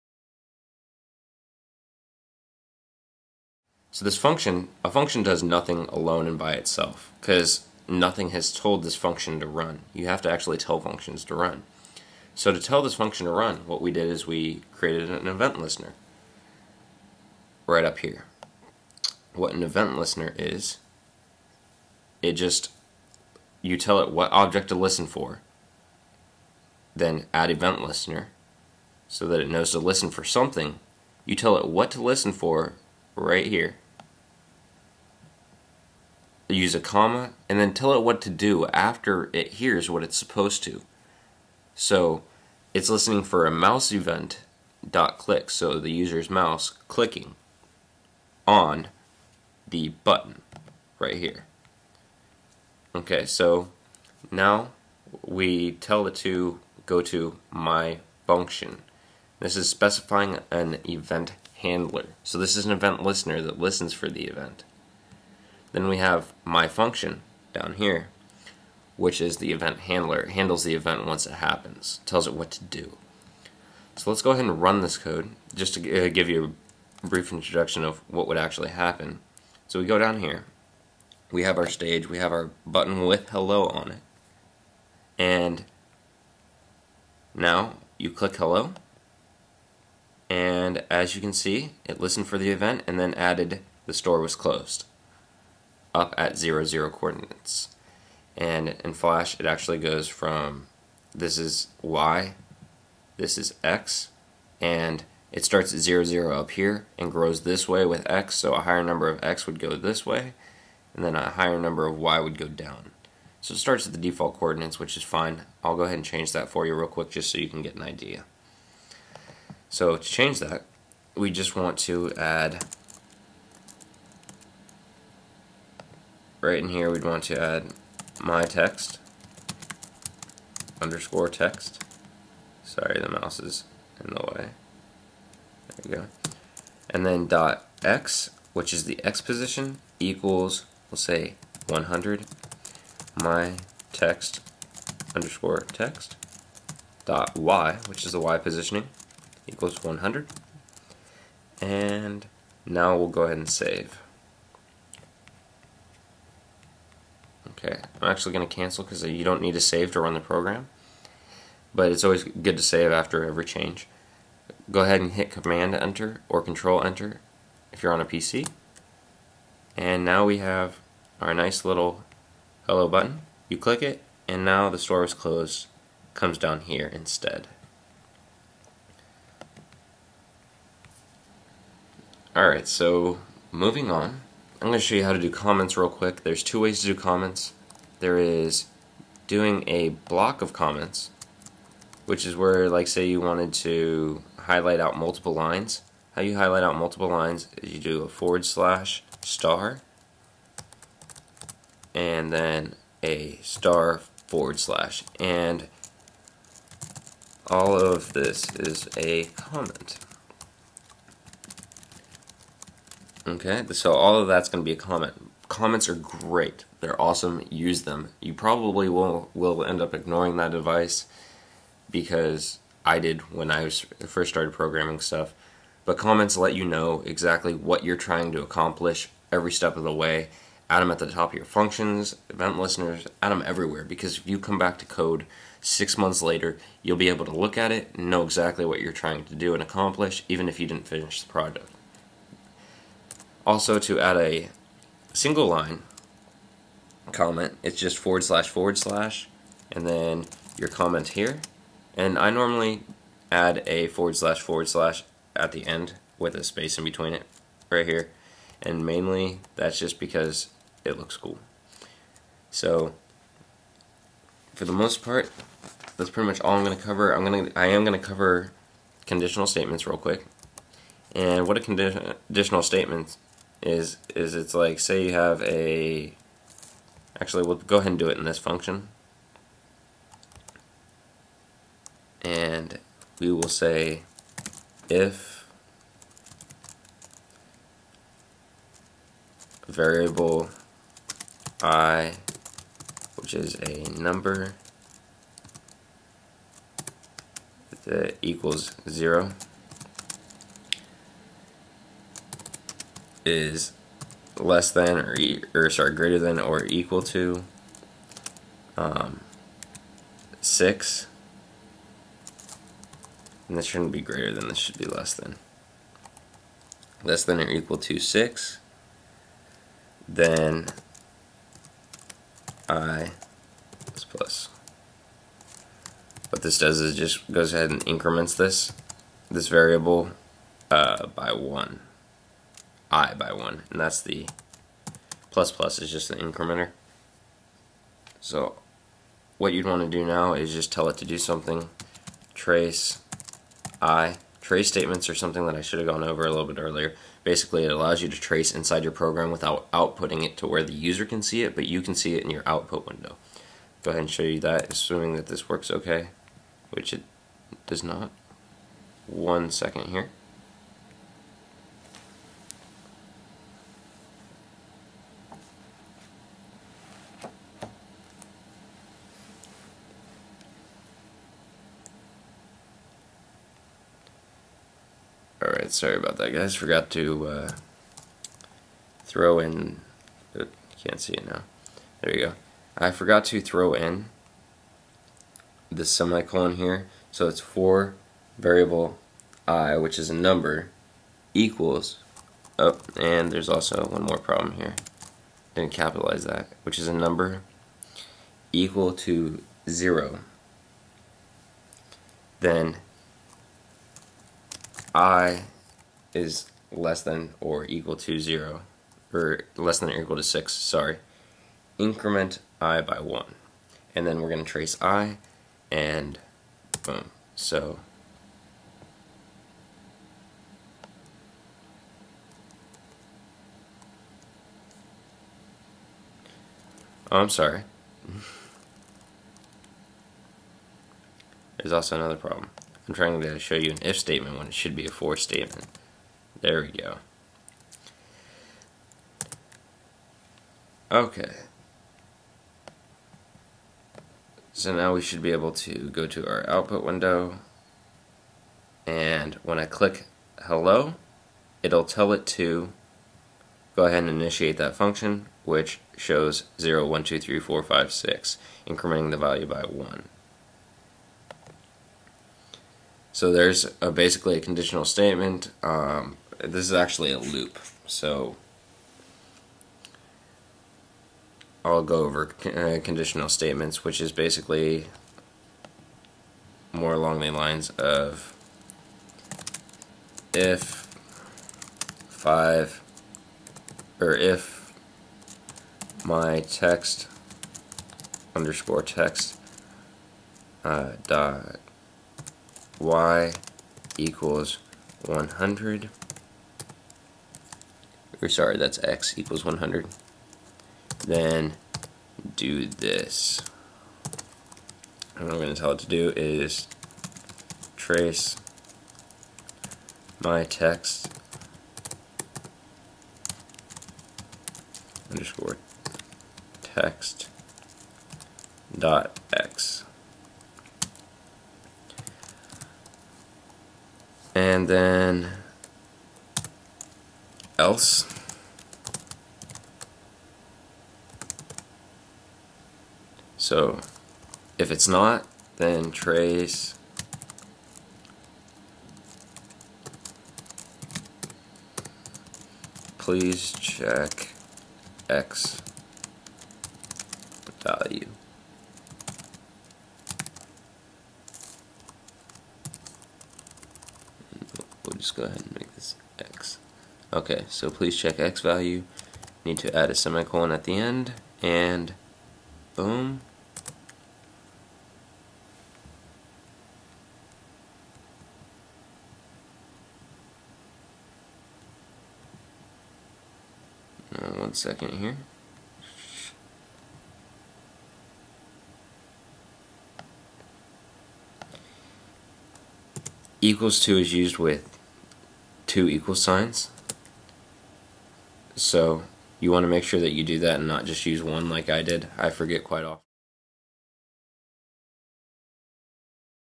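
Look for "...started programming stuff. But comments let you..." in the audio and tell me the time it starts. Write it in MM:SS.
03:44.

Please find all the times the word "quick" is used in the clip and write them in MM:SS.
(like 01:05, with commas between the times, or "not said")
01:56, 03:05, 04:29.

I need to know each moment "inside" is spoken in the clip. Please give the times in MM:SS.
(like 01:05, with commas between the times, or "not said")
05:48.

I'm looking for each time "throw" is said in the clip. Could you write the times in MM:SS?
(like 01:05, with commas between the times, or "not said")
06:19, 06:23.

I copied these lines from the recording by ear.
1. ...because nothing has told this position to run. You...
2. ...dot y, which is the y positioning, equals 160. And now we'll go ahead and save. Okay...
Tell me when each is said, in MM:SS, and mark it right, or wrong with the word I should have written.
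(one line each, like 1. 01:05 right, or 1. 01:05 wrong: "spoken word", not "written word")
1. 00:07 wrong: "function", not "position"
2. 02:27 wrong: "100", not "160".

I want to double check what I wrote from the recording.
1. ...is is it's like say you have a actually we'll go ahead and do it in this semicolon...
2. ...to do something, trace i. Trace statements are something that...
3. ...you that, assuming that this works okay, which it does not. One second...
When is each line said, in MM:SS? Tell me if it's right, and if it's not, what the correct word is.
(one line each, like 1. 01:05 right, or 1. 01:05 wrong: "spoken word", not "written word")
1. 04:33 wrong: "function", not "semicolon"
2. 05:40 right
3. 05:54 right.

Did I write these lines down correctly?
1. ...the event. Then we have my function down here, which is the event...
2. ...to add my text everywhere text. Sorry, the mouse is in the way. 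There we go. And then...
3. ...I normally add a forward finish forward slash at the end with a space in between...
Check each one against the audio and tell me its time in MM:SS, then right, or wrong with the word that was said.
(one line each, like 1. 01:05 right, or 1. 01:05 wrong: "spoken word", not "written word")
1. 01:04 right
2. 02:07 wrong: "underscore", not "everywhere"
3. 04:12 wrong: "slash", not "finish".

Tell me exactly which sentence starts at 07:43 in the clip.
So there's a, basically a conditional statement.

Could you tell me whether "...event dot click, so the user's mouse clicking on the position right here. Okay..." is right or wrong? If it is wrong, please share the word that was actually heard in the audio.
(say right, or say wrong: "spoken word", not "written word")
wrong: "button", not "position".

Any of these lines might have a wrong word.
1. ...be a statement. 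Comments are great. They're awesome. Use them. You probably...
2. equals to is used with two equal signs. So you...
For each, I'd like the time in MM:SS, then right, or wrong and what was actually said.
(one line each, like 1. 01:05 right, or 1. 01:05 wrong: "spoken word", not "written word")
1. 03:34 wrong: "comment", not "statement"
2. 09:43 right.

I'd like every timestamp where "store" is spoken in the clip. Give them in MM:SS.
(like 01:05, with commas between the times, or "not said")
01:33, 02:54.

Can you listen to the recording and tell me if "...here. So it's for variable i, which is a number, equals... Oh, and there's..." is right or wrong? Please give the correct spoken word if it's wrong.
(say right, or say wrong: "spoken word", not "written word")
right.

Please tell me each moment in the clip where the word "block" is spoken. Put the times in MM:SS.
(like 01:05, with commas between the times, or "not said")
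03:09.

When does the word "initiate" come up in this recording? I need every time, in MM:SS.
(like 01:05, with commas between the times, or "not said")
07:34.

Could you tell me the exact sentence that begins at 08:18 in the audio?
Or sorry, that's x equals 100.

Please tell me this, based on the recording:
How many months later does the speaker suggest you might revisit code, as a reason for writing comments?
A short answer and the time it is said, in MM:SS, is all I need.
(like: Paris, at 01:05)
6, at 03:55.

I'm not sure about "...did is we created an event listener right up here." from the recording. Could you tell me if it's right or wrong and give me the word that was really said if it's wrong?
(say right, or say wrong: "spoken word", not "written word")
right.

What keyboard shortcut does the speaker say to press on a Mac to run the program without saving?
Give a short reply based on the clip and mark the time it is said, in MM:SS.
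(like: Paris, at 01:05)
Command Enter, at 02:45.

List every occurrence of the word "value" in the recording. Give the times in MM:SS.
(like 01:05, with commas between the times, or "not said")
07:39, 09:07, 09:18.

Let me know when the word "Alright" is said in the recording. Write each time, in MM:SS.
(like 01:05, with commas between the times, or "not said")
03:02, 06:15.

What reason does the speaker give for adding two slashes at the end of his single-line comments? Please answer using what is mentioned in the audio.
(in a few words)
it looks cool.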